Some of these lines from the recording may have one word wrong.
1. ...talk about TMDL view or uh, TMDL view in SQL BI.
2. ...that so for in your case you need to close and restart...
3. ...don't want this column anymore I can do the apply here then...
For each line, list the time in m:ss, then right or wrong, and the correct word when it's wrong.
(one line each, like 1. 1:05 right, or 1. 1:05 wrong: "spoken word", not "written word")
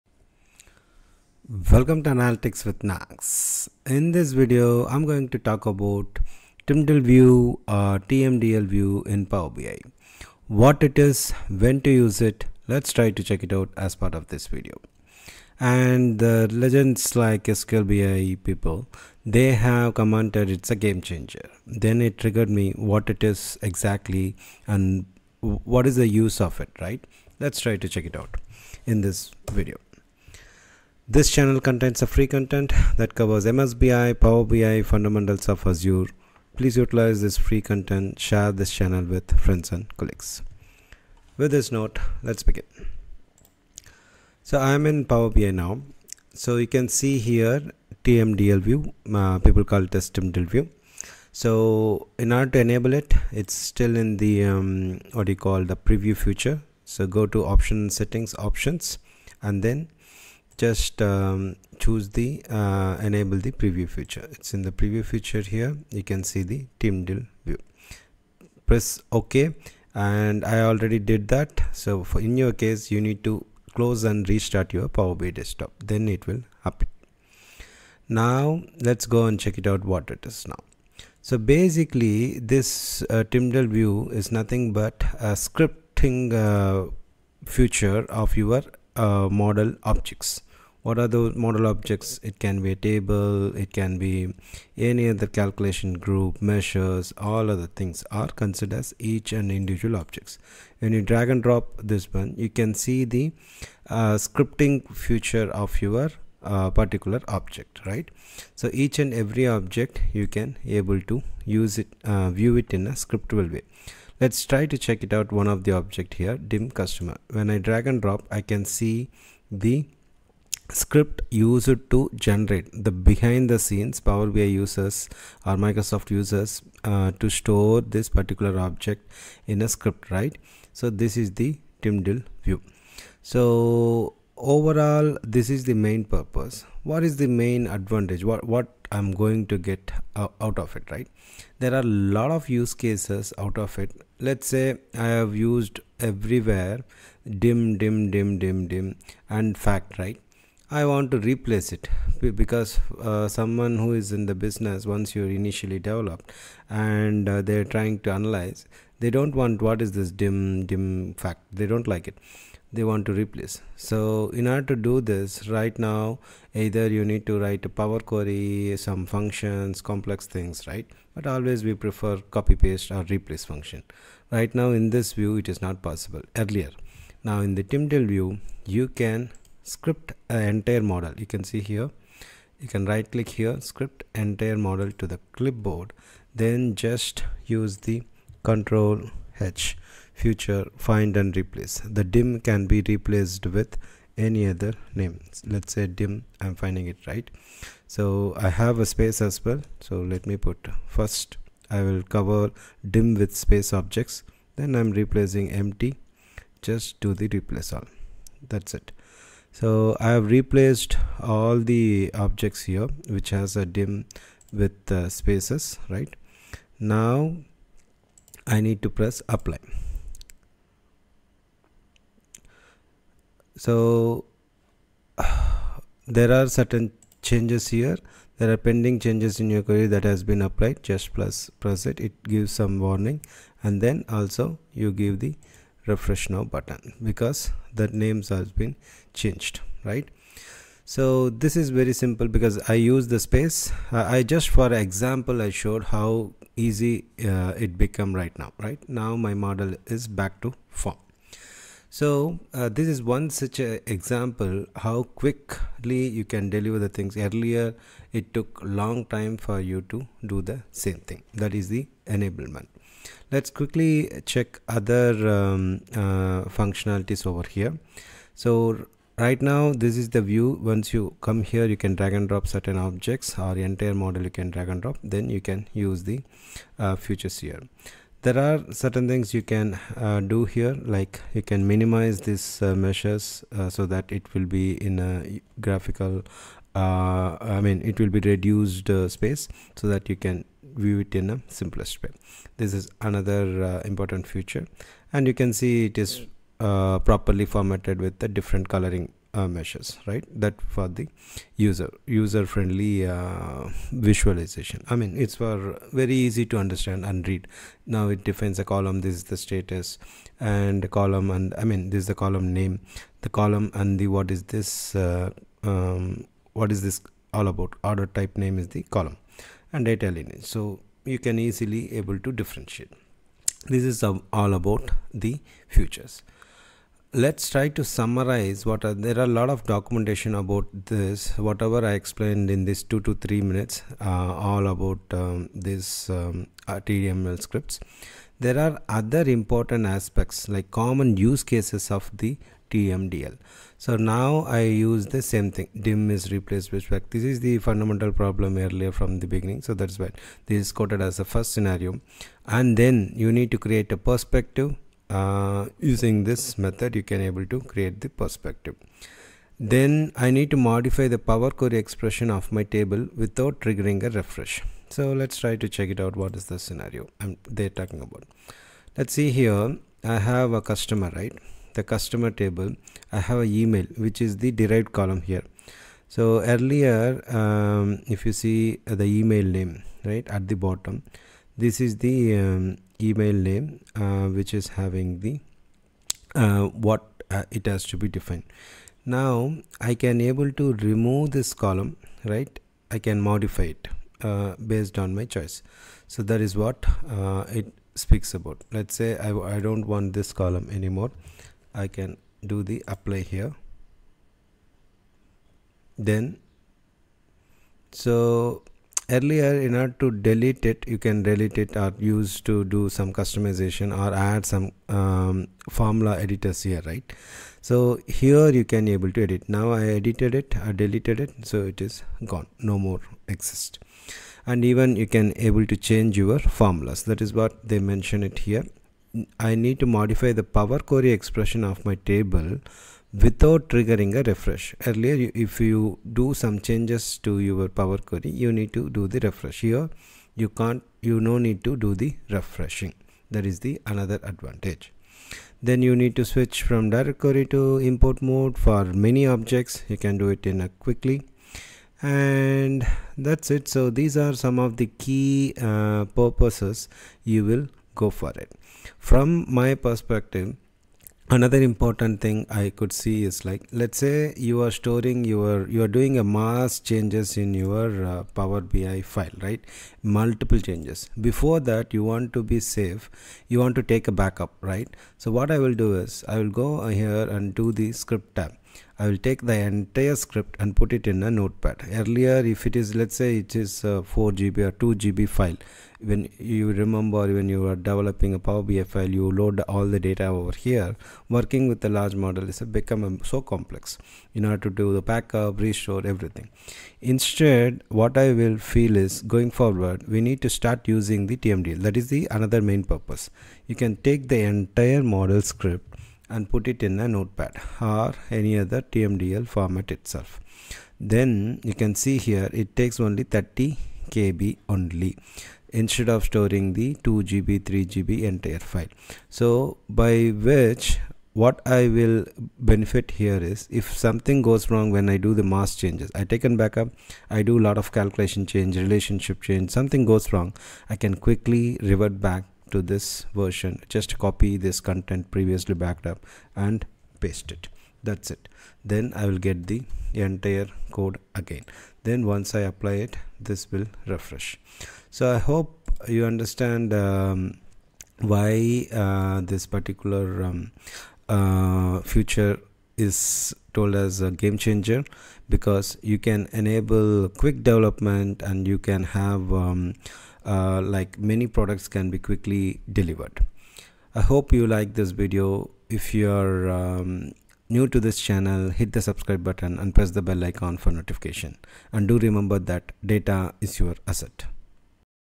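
1. 0:05 wrong: "Power", not "SQL"
2. 1:11 right
3. 6:39 right.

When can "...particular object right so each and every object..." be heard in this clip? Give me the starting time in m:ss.
1:46.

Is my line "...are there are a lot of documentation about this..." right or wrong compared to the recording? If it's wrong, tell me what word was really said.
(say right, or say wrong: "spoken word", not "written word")
right.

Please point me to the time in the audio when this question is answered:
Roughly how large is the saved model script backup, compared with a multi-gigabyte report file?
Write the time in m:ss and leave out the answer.
8:33.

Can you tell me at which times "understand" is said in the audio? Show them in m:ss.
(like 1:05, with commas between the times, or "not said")
5:06, 9:06.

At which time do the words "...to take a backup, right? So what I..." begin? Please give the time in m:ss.
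7:53.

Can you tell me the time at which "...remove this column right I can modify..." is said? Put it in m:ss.
6:30.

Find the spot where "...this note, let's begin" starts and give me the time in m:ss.
0:41.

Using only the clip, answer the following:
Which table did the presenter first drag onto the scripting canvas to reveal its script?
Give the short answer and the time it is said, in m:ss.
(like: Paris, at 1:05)
dim customer, at 1:56.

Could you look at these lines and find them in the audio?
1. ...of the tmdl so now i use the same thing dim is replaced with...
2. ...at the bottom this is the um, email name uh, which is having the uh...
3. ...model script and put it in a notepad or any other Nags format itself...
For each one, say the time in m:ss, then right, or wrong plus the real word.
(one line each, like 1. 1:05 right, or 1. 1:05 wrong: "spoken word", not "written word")
1. 5:41 right
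2. 6:20 right
3. 8:25 wrong: "TMDL", not "Nags".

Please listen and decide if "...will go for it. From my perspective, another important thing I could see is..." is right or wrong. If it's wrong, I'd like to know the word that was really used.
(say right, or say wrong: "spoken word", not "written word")
right.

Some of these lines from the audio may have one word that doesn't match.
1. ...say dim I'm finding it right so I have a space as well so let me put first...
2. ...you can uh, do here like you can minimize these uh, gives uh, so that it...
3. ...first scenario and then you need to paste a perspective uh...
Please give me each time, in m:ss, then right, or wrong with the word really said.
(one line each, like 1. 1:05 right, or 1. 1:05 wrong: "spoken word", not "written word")
1. 3:15 right
2. 4:39 wrong: "meshes", not "gives"
3. 5:51 wrong: "create", not "paste".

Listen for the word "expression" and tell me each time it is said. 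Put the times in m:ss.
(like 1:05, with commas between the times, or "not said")
6:01, 7:11.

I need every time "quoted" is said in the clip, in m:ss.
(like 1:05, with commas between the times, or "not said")
5:50.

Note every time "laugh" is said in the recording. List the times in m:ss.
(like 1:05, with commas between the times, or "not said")
not said.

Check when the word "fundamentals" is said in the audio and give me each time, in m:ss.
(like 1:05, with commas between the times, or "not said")
0:34, 5:47.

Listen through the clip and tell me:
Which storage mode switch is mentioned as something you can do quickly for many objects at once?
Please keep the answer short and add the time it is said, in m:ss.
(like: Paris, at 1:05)
direct query to import, at 7:26.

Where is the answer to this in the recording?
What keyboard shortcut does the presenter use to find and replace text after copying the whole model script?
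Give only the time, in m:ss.
3:08.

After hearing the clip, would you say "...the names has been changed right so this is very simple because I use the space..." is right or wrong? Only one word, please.
right.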